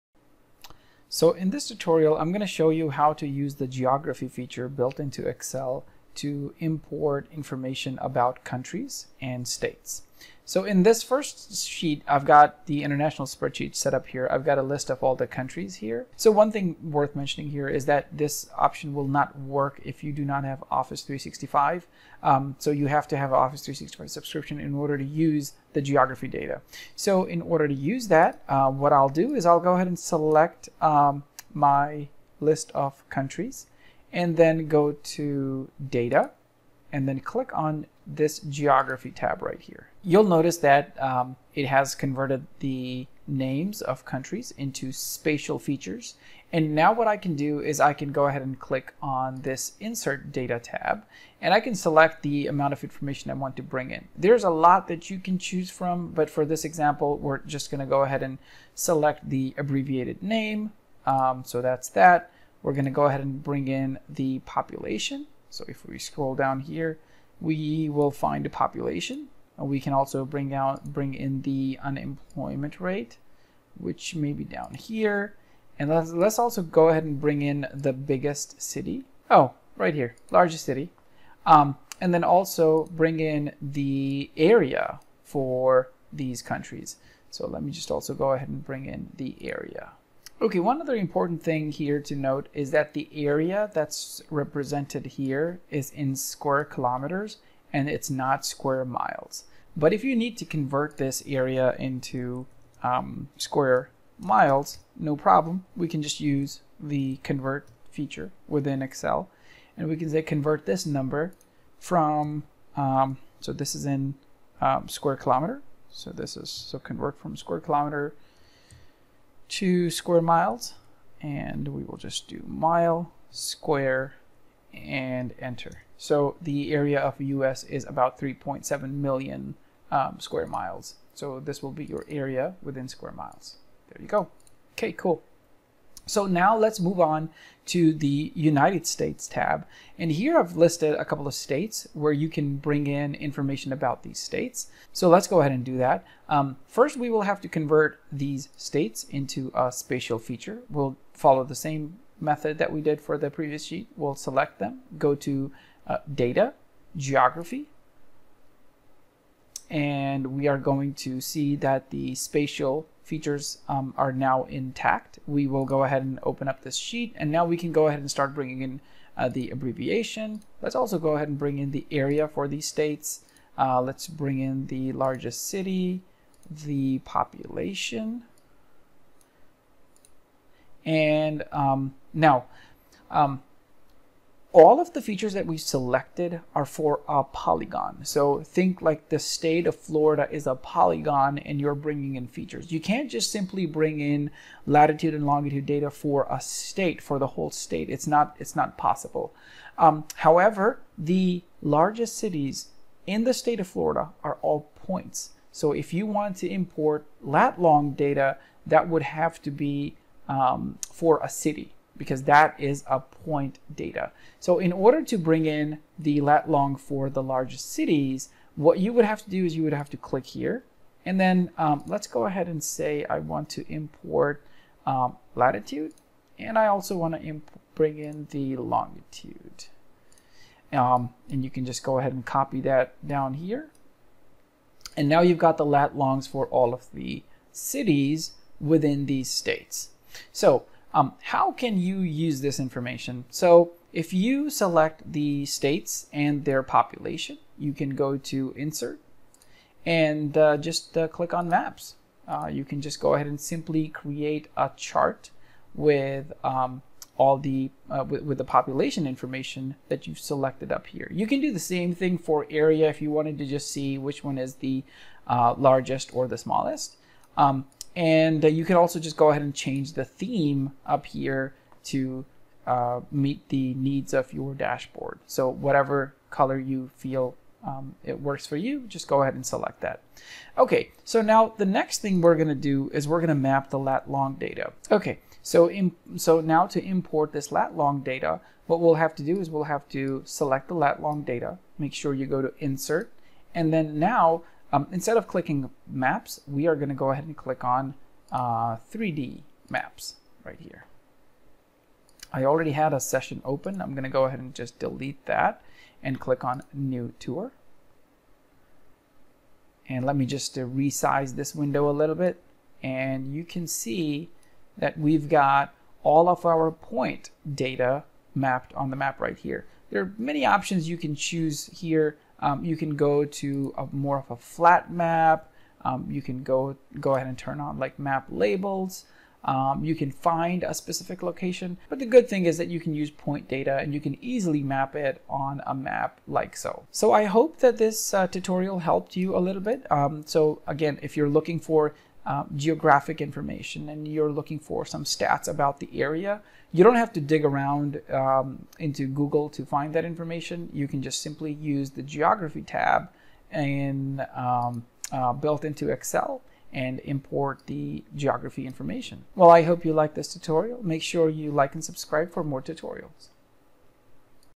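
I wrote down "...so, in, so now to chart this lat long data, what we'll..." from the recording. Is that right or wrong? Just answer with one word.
wrong.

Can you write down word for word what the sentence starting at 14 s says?
I've got a list of all the countries here.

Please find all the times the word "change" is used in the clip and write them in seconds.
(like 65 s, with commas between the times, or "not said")
269 s.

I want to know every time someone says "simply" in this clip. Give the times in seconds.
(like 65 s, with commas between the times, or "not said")
193 s, 253 s, 351 s.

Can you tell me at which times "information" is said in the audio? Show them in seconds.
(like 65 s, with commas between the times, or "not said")
7 s, 52 s, 143 s, 242 s, 259 s, 343 s, 350 s, 358 s.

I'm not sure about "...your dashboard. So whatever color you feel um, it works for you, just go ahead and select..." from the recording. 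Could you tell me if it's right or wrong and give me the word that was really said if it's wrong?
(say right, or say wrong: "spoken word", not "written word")
right.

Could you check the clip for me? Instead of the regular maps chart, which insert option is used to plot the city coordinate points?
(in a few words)
3D maps.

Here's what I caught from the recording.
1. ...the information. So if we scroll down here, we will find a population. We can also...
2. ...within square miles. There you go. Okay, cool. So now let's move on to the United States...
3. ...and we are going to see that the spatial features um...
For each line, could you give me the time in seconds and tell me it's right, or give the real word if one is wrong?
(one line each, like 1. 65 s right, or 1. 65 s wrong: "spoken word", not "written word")
1. 64 s wrong: "population", not "information"
2. 132 s right
3. 159 s right.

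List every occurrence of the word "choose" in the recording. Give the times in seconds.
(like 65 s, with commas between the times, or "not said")
55 s, 321 s.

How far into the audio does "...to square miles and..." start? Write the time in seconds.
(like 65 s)
119 s.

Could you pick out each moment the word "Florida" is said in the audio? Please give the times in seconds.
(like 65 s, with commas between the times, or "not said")
189 s, 203 s.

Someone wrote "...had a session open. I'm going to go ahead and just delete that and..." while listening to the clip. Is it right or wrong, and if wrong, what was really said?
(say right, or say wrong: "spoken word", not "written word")
right.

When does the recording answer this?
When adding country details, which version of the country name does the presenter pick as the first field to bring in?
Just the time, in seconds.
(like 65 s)
59 s.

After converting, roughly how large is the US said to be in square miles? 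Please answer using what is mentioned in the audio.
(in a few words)
3.7 million.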